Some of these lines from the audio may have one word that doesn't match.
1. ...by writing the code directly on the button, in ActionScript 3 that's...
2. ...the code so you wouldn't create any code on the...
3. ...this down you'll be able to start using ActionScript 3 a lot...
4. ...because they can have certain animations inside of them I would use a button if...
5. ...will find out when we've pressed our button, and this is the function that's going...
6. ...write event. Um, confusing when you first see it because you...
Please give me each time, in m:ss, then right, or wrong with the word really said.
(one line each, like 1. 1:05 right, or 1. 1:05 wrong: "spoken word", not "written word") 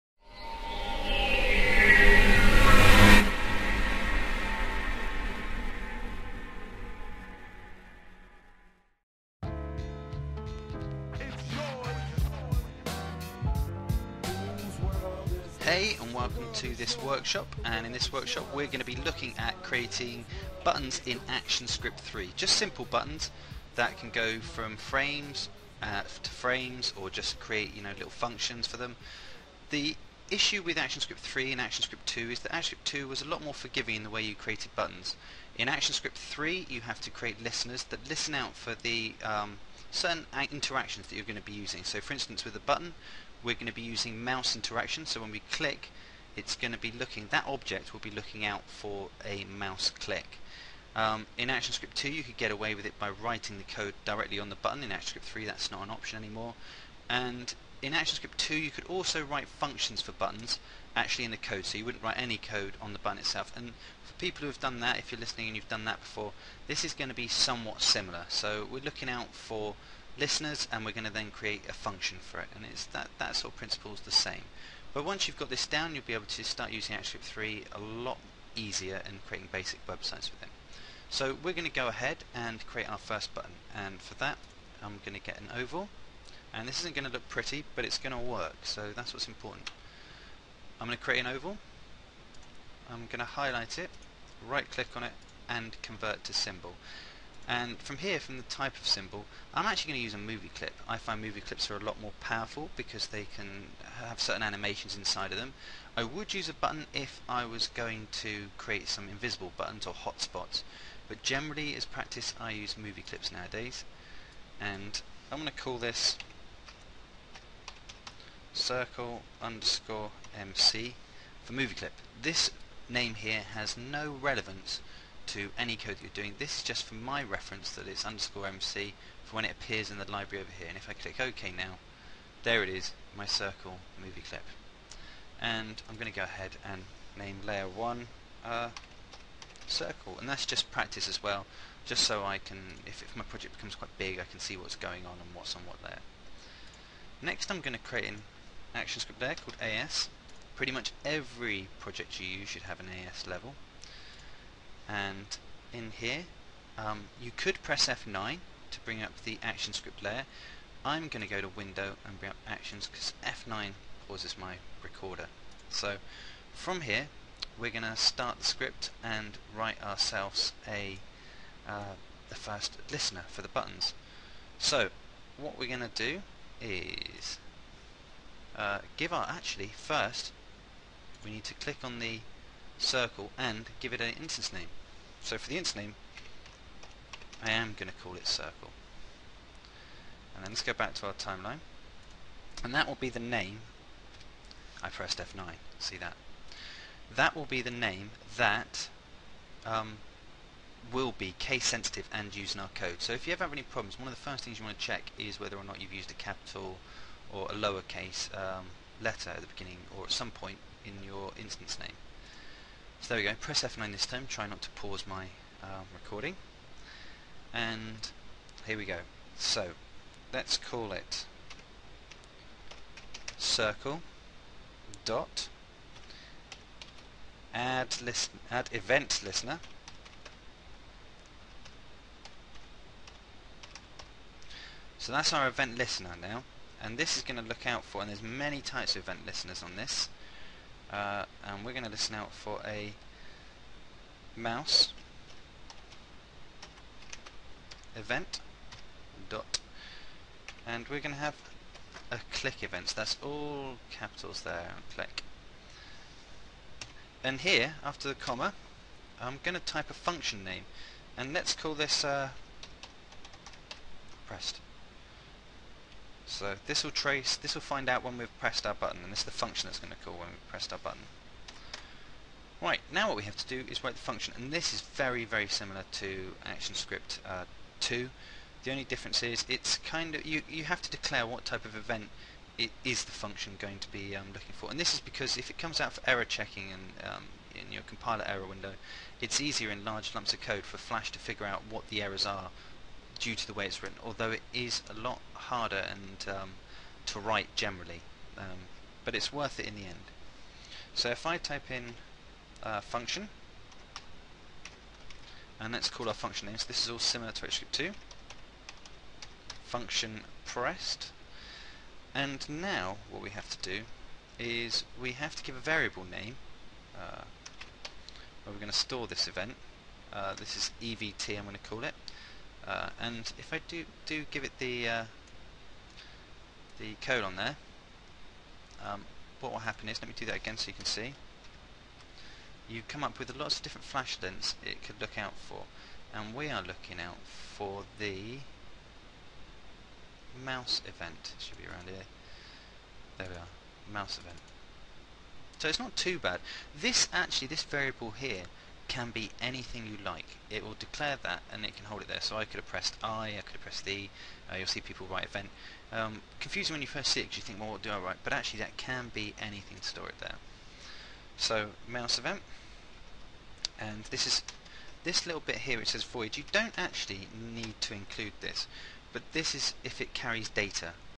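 1. 0:52 right
2. 1:01 wrong: "write", not "create"
3. 1:15 right
4. 1:42 right
5. 4:27 right
6. 5:55 right.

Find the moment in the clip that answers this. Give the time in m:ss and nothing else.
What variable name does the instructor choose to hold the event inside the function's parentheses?
5:20.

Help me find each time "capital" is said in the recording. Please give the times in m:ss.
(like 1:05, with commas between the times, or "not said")
3:26, 4:13.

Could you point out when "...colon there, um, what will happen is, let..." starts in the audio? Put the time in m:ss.
5:27.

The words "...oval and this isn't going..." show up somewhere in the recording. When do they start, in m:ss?
1:25.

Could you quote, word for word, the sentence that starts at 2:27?
Next I'm going to create an action script layer called AS.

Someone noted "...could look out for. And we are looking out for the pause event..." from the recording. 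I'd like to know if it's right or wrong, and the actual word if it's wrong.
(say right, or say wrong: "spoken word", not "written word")
wrong: "mouse", not "pause".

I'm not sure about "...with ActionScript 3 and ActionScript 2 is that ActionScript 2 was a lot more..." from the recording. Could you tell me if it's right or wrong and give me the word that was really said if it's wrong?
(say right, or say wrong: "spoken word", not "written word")
right.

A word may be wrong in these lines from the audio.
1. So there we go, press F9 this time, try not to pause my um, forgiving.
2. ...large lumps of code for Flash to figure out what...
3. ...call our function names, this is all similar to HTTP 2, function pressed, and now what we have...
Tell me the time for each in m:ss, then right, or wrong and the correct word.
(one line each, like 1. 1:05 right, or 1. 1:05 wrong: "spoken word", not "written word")
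1. 3:33 wrong: "recording", not "forgiving"
2. 4:49 right
3. 5:05 right.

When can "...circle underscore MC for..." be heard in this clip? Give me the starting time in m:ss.
1:58.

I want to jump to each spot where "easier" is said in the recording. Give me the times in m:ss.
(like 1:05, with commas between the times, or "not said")
1:18, 4:49.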